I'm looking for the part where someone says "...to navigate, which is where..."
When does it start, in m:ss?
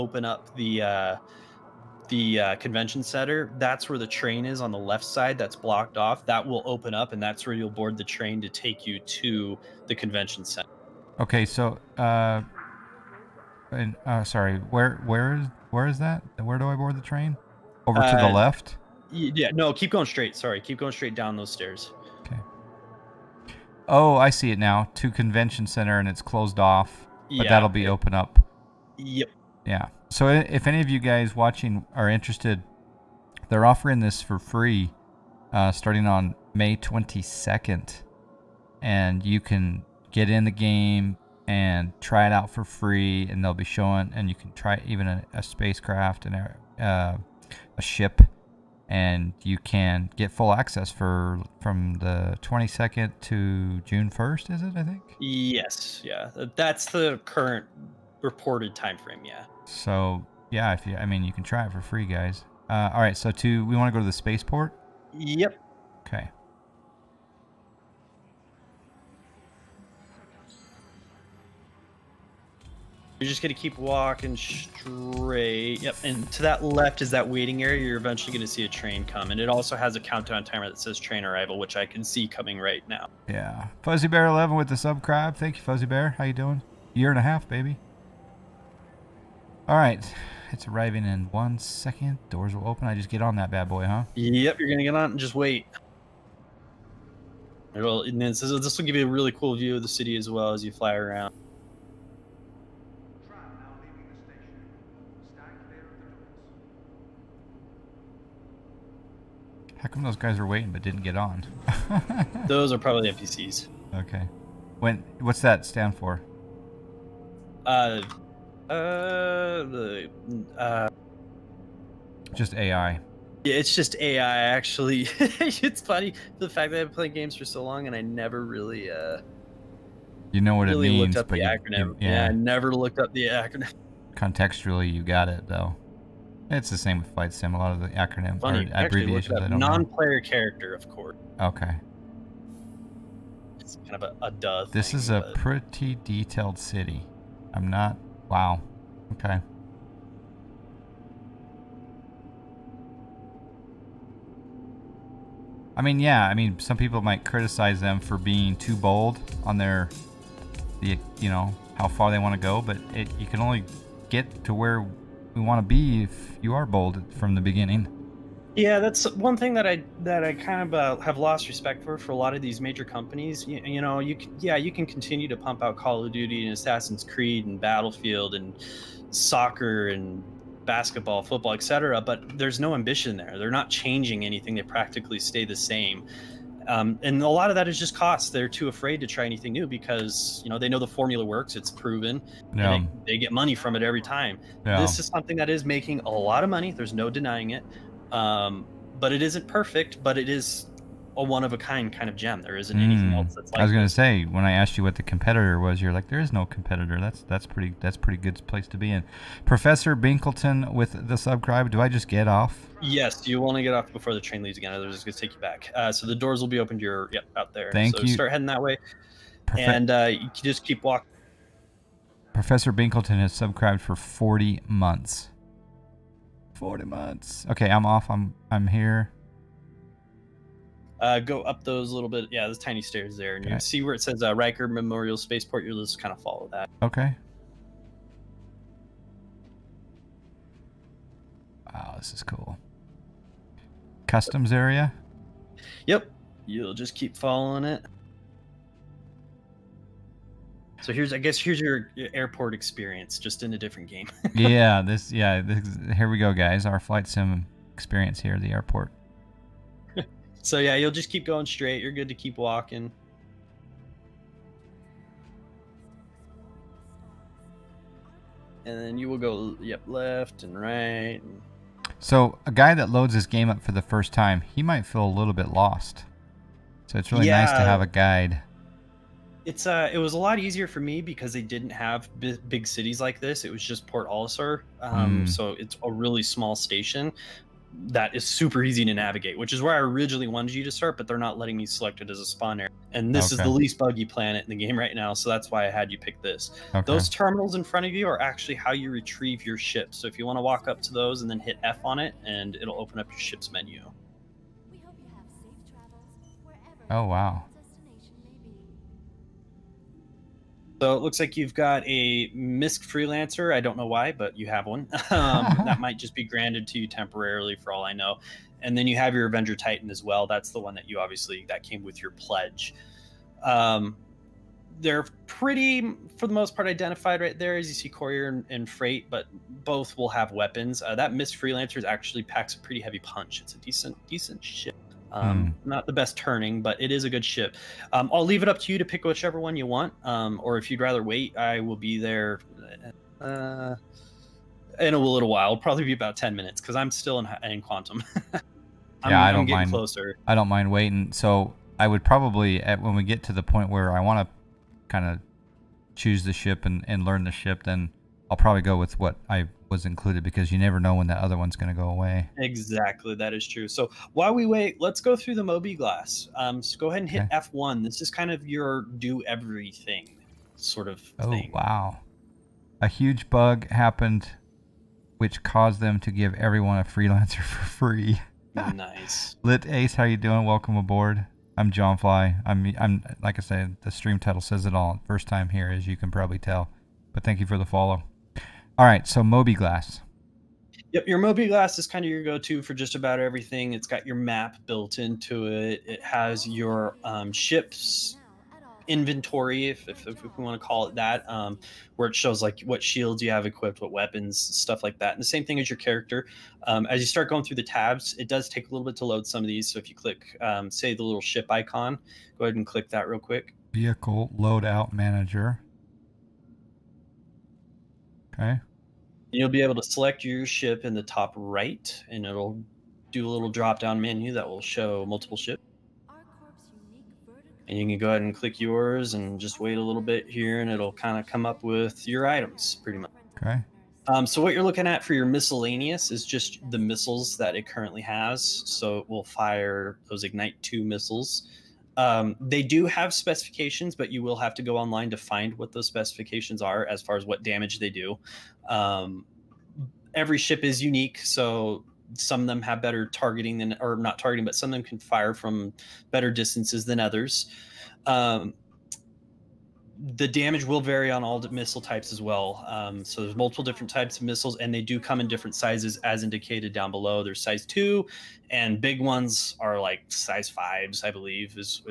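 4:48.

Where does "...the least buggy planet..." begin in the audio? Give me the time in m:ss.
4:53.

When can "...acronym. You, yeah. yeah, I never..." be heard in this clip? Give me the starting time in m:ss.
2:11.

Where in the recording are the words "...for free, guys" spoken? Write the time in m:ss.
1:01.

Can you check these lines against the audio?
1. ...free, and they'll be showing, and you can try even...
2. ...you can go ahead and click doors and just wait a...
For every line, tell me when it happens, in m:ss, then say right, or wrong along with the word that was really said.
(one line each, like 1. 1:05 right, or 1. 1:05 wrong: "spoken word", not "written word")
1. 0:42 right
2. 7:07 wrong: "yours", not "doors".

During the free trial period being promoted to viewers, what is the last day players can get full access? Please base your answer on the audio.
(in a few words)
June 1st.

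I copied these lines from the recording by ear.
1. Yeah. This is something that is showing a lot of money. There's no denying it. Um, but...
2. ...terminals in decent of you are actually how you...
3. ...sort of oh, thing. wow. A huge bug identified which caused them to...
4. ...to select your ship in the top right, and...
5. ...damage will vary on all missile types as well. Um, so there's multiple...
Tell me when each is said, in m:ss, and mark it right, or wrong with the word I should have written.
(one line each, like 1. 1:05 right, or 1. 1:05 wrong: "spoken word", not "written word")
1. 3:14 wrong: "making", not "showing"
2. 4:57 wrong: "front", not "decent"
3. 6:10 wrong: "happened", not "identified"
4. 6:59 right
5. 7:40 right.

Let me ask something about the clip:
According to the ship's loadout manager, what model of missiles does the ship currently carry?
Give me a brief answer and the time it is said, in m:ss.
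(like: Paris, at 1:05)
Ignite 2, at 7:20.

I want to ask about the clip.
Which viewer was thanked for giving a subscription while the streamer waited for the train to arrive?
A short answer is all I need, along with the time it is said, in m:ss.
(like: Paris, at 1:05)
Fuzzy Bear 11, at 1:23.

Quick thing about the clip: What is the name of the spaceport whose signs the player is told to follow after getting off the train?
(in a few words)
Riker Memorial Spaceport.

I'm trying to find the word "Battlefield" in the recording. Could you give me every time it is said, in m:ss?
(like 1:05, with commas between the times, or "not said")
2:57.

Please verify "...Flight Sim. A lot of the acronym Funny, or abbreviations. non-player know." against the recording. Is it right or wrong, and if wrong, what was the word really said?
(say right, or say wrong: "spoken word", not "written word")
right.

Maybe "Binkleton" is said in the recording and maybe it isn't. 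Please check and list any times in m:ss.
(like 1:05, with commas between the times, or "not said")
3:29, 3:42.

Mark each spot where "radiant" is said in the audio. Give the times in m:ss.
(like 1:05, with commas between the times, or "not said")
not said.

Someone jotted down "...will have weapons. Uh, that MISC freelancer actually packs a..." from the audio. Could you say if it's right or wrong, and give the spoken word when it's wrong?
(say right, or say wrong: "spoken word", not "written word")
right.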